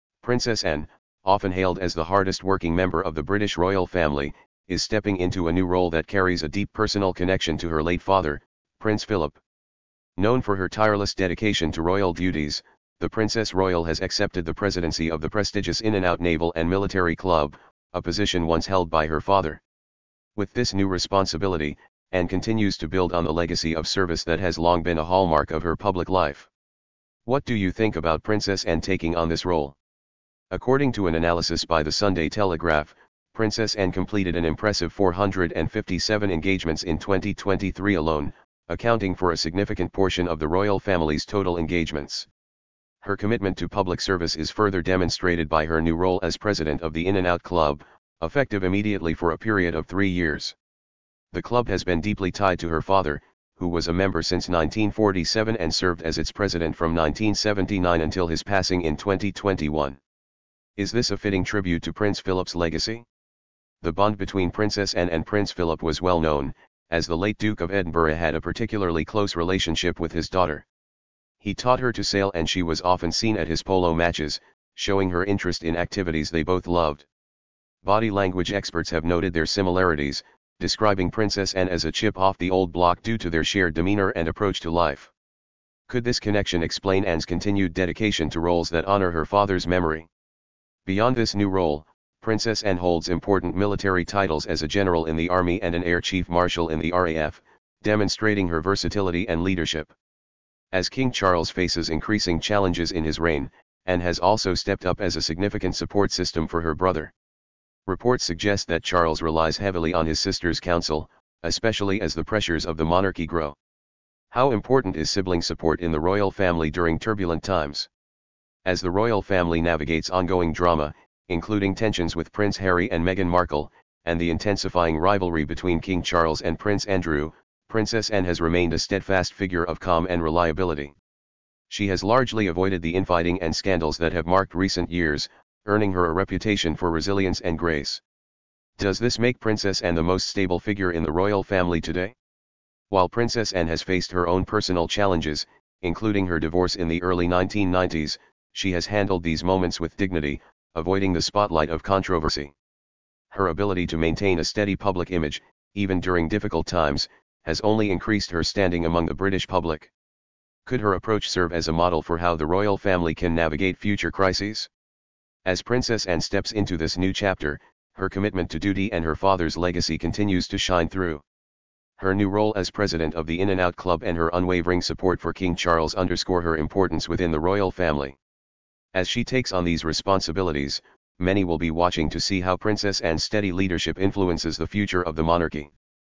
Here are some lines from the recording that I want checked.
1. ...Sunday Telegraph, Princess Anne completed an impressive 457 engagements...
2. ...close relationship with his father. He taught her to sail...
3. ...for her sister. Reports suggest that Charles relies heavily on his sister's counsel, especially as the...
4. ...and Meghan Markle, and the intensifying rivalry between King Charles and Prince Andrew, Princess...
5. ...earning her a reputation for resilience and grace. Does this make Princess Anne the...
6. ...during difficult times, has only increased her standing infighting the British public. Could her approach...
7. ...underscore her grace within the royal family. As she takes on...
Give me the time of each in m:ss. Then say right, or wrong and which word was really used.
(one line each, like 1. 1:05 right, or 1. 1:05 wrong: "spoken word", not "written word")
1. 0:31 right
2. 1:09 wrong: "daughter", not "father"
3. 1:46 wrong: "brother", not "sister"
4. 2:02 right
5. 2:15 right
6. 2:36 wrong: "among", not "infighting"
7. 2:55 wrong: "importance", not "grace".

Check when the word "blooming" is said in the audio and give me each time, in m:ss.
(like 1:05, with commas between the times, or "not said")
not said.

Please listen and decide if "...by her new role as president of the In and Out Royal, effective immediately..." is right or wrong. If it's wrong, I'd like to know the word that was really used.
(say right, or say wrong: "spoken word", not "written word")
wrong: "Club", not "Royal".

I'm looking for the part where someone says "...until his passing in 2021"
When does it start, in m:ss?
0:58.